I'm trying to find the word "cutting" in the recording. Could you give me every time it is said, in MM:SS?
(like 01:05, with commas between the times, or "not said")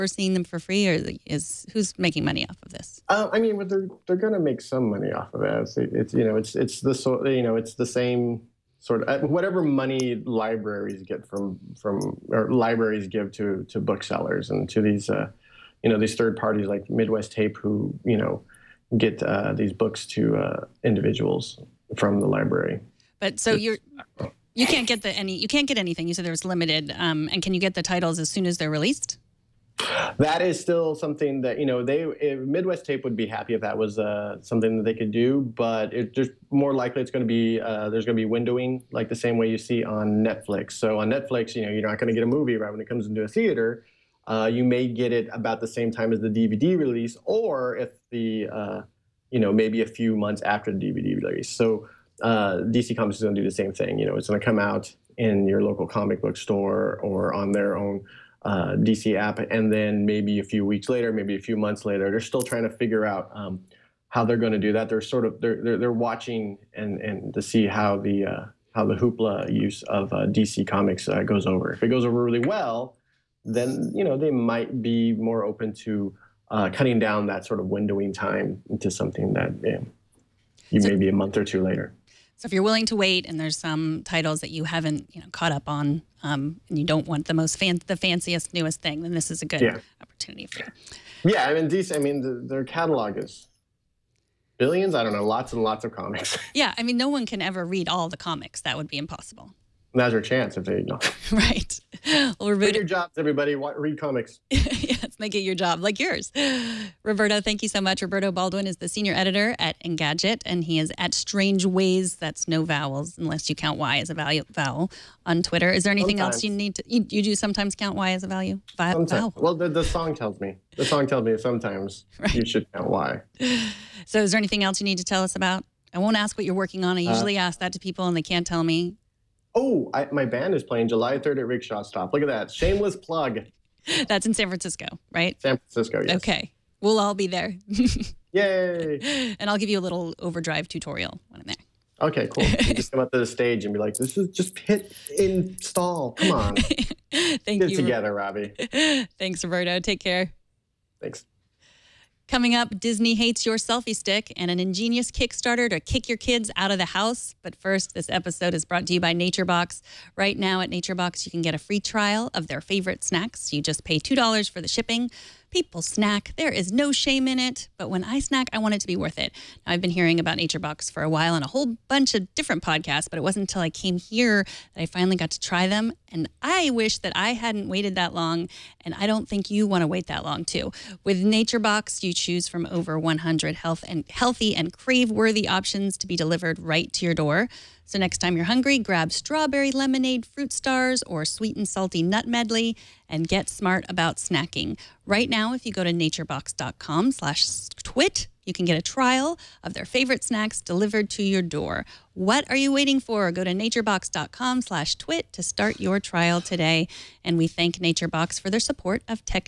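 01:16.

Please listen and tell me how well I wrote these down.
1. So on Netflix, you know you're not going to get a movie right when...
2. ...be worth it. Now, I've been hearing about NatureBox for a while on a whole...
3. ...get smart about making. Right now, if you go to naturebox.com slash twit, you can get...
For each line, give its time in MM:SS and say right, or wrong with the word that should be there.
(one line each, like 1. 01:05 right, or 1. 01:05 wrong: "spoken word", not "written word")
1. 00:40 right
2. 02:48 right
3. 03:13 wrong: "snacking", not "making".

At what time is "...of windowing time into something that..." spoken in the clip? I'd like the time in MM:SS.
01:17.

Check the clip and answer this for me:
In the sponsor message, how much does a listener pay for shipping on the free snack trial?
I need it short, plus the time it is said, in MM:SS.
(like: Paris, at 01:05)
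$2, at 02:43.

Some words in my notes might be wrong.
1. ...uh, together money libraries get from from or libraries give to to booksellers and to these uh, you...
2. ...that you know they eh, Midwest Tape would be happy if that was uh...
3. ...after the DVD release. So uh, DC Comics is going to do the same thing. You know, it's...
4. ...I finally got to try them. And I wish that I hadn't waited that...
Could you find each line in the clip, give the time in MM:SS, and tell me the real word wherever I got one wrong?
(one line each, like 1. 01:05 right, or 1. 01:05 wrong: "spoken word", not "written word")
1. 00:09 wrong: "whatever", not "together"
2. 00:31 right
3. 00:50 right
4. 02:54 right.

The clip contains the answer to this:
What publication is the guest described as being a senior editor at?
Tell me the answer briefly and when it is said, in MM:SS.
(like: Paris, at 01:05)
Engadget, at 01:49.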